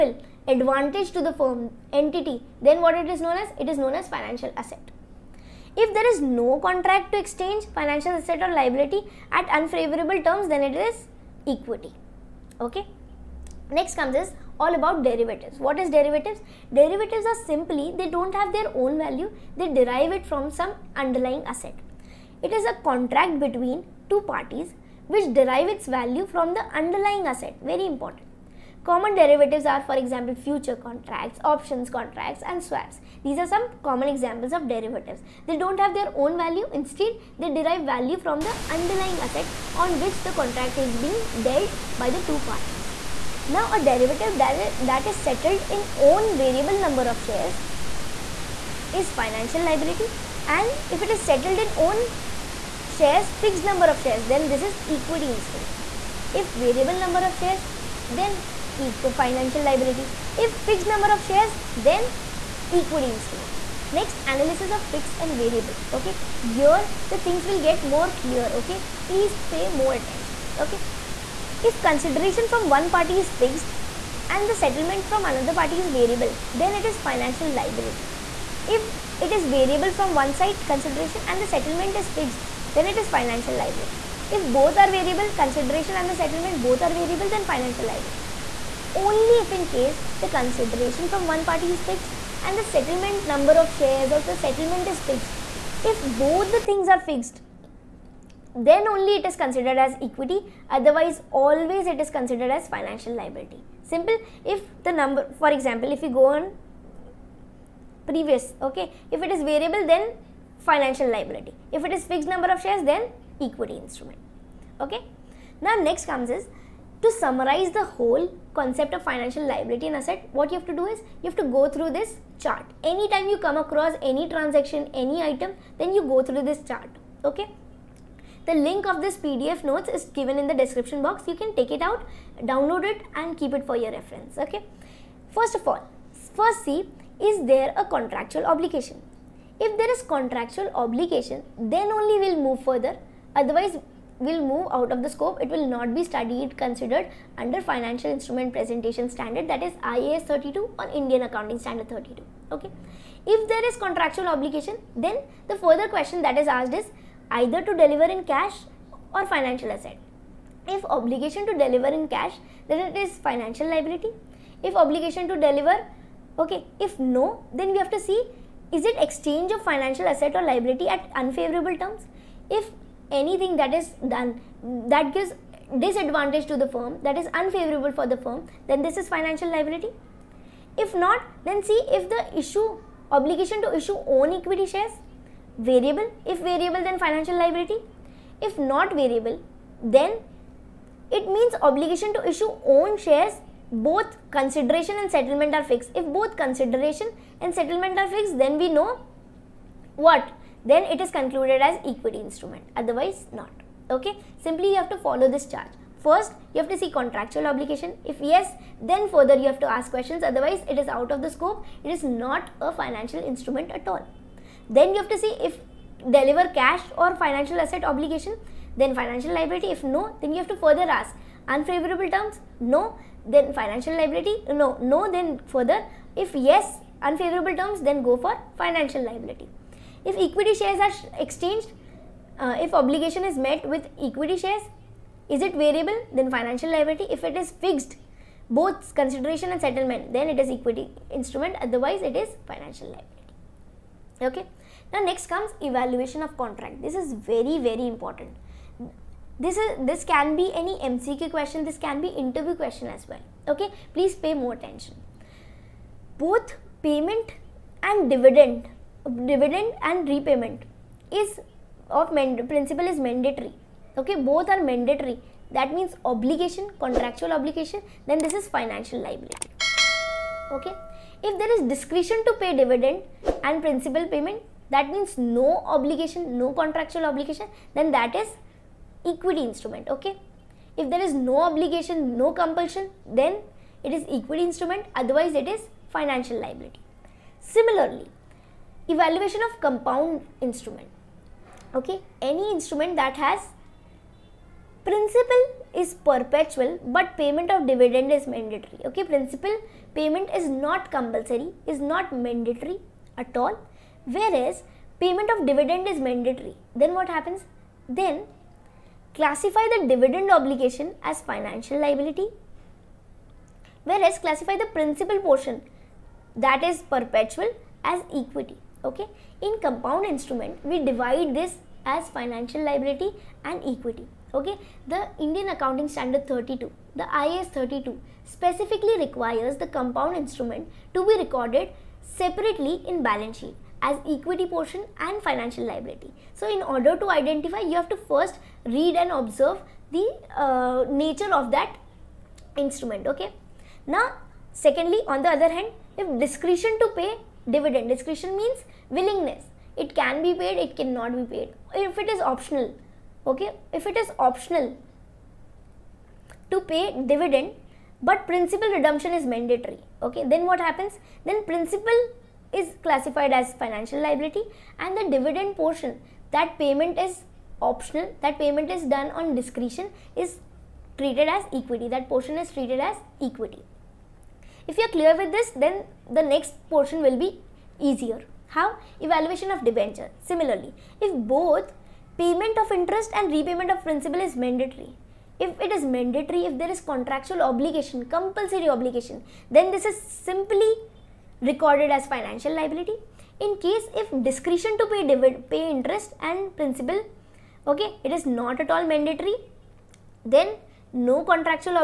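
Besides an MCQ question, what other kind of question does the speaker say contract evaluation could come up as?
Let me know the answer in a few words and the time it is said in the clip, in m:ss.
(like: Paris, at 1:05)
Interview question, at 4:12.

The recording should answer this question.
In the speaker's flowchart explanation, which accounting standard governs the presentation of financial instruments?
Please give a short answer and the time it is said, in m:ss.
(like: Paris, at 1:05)
IAS 32, at 2:29.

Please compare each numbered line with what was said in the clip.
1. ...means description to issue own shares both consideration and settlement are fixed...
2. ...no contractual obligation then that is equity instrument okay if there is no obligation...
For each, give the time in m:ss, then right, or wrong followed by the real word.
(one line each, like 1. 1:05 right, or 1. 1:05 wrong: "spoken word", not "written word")
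1. 3:11 wrong: "obligation", not "description"
2. 4:36 right.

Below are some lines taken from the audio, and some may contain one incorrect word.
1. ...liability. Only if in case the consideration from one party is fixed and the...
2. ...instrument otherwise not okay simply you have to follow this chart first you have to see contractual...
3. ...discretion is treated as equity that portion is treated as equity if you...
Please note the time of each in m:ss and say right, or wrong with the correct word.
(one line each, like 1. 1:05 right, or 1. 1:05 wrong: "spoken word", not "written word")
1. 1:27 right
2. 3:22 right
3. 6:09 right.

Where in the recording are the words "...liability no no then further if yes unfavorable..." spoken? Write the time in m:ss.
3:43.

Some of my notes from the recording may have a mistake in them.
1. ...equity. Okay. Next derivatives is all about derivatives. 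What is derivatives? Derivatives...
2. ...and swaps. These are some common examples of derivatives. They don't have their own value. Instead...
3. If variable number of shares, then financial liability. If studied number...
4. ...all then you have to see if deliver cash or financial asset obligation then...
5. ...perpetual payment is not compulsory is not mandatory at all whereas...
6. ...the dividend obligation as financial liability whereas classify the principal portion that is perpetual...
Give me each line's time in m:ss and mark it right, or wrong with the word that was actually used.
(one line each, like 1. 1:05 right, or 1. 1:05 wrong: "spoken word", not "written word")
1. 0:11 wrong: "comes", not "derivatives"
2. 0:32 right
3. 0:56 wrong: "fixed", not "studied"
4. 3:33 right
5. 4:59 wrong: "principal", not "perpetual"
6. 5:09 right.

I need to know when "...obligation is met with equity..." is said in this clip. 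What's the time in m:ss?
3:52.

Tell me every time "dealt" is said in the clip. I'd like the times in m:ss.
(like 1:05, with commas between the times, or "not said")
0:41.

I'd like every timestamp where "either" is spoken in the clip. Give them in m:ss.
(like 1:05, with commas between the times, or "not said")
2:37.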